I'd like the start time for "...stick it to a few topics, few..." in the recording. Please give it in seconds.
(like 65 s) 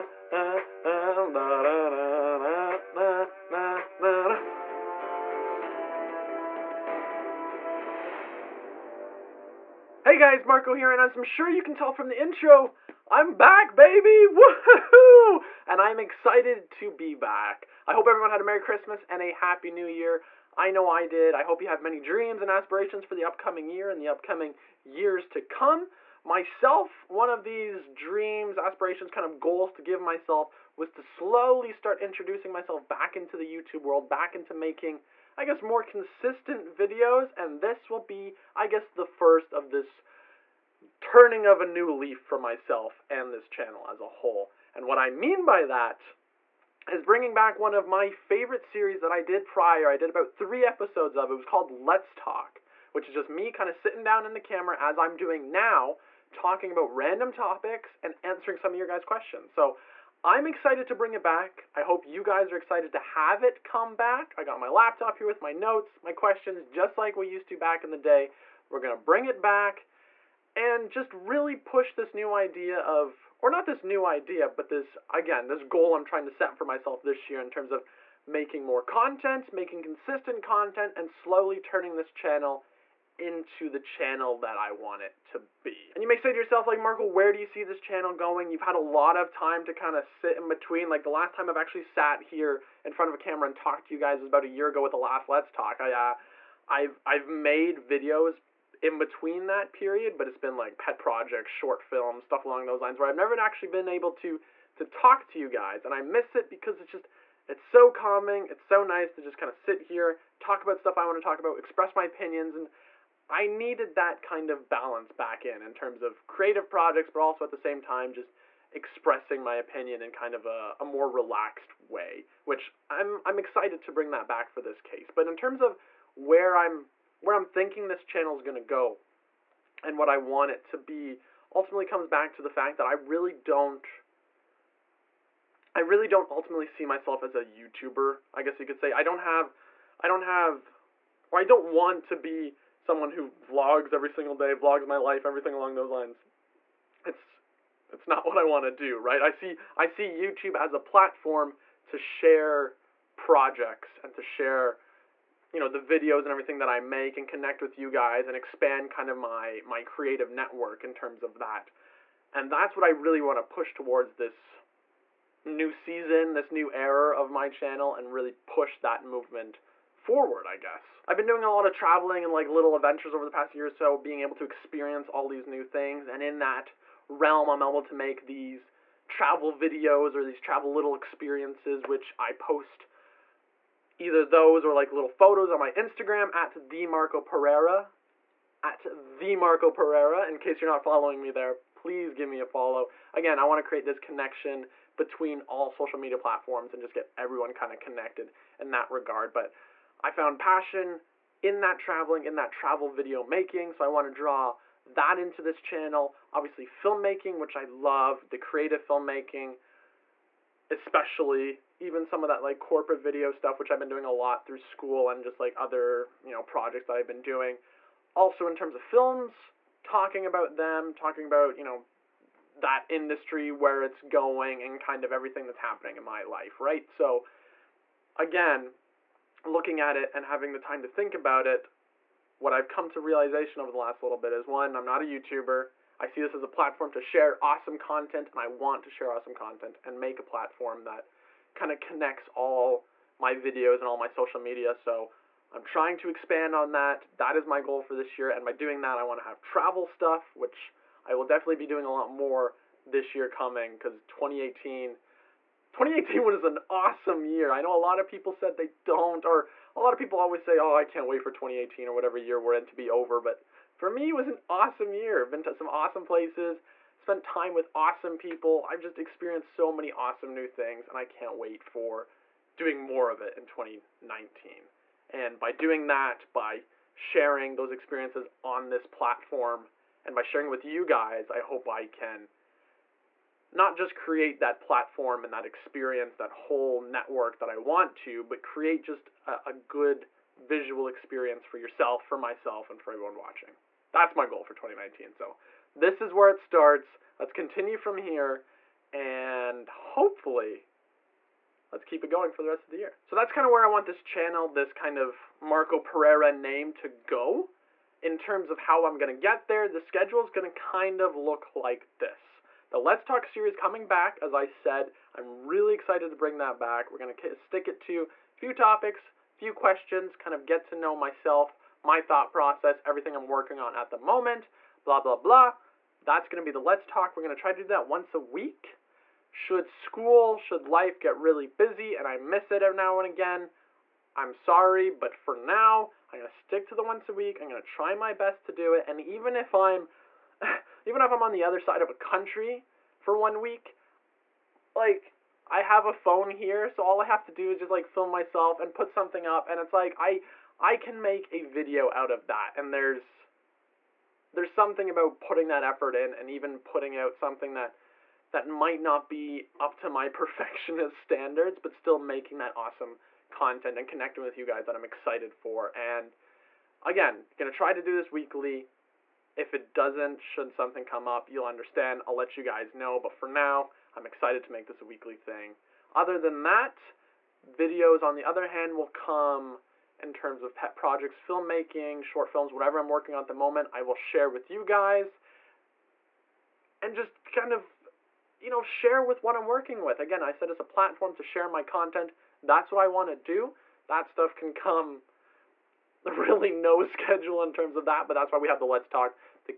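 317 s.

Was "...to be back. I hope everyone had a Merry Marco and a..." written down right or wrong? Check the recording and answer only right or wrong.
wrong.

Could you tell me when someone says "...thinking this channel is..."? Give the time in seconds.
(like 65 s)
127 s.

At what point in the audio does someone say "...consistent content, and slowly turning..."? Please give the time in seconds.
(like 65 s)
79 s.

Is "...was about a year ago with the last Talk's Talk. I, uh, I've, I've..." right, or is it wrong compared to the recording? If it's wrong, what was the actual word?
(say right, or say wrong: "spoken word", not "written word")
wrong: "Let", not "Talk".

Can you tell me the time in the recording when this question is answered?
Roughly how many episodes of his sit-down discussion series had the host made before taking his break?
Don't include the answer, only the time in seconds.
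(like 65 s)
50 s.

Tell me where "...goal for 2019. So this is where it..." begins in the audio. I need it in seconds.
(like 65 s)
294 s.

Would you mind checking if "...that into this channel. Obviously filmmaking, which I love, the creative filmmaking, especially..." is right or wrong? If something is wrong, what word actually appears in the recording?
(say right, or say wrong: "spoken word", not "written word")
right.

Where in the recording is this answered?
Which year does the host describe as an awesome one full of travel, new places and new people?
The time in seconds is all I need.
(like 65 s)
254 s.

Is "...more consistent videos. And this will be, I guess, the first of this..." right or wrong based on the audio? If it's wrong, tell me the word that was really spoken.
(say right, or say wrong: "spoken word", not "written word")
right.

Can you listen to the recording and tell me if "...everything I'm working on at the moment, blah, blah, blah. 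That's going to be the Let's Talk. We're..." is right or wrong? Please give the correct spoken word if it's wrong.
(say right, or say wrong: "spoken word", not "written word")
right.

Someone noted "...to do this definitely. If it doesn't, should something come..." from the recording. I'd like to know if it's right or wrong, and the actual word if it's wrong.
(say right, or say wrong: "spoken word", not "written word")
wrong: "weekly", not "definitely".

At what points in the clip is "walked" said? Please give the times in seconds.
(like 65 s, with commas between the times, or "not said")
not said.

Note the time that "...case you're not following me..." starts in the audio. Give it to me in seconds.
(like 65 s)
190 s.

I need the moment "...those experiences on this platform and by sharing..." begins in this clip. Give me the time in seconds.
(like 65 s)
277 s.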